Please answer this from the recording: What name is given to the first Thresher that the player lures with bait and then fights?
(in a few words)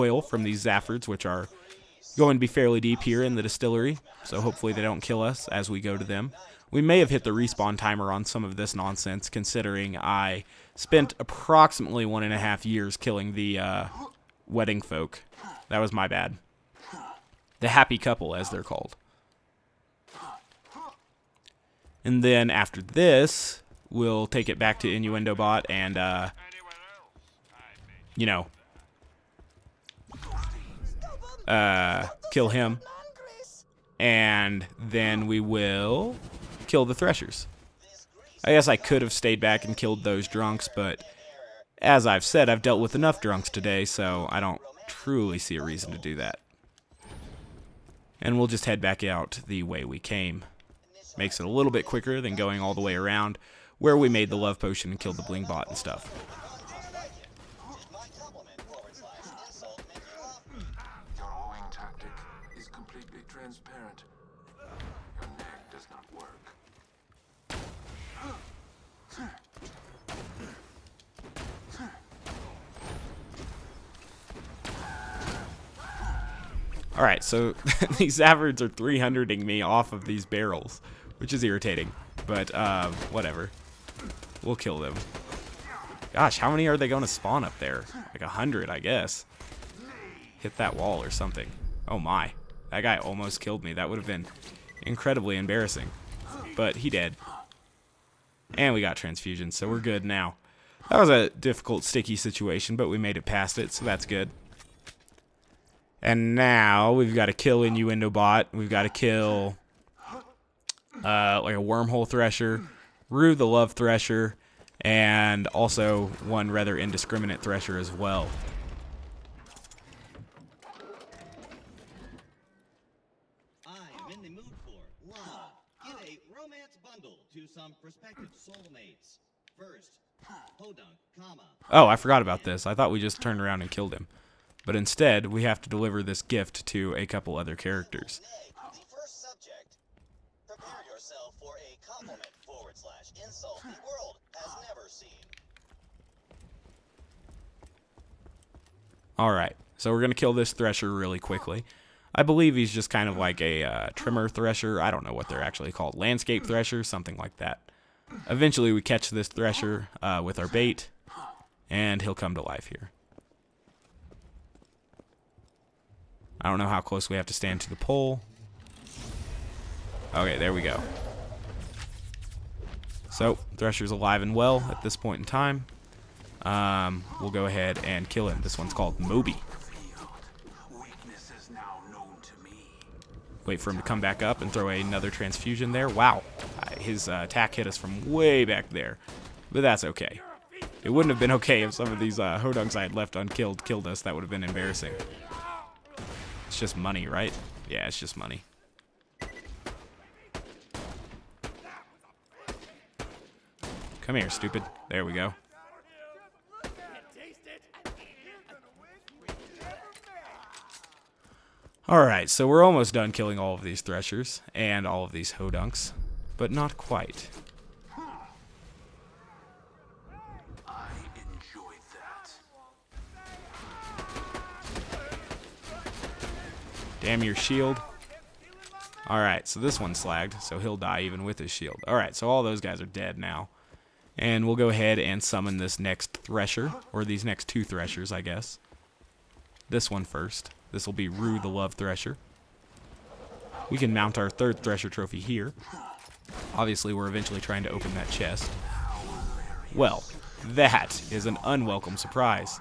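Moby.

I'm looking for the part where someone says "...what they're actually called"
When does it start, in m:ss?
2:35.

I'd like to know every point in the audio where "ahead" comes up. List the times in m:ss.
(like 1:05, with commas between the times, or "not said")
2:57, 3:54.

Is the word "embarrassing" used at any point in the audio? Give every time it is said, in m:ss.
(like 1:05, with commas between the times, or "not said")
1:35, 3:14.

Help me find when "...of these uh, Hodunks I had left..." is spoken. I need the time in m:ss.
3:11.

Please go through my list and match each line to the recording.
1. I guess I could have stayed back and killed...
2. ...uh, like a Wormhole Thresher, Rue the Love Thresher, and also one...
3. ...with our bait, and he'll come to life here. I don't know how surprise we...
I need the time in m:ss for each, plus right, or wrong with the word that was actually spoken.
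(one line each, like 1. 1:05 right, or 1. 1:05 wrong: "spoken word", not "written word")
1. 0:38 right
2. 1:51 right
3. 2:40 wrong: "close", not "surprise".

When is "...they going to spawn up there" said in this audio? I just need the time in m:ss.
1:26.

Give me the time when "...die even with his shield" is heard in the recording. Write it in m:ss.
3:50.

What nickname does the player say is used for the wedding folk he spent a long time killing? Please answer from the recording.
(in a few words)
The happy couple.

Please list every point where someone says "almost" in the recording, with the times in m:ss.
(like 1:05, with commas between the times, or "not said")
1:32, 3:32.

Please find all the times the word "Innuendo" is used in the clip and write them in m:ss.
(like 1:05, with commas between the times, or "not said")
0:24, 1:47.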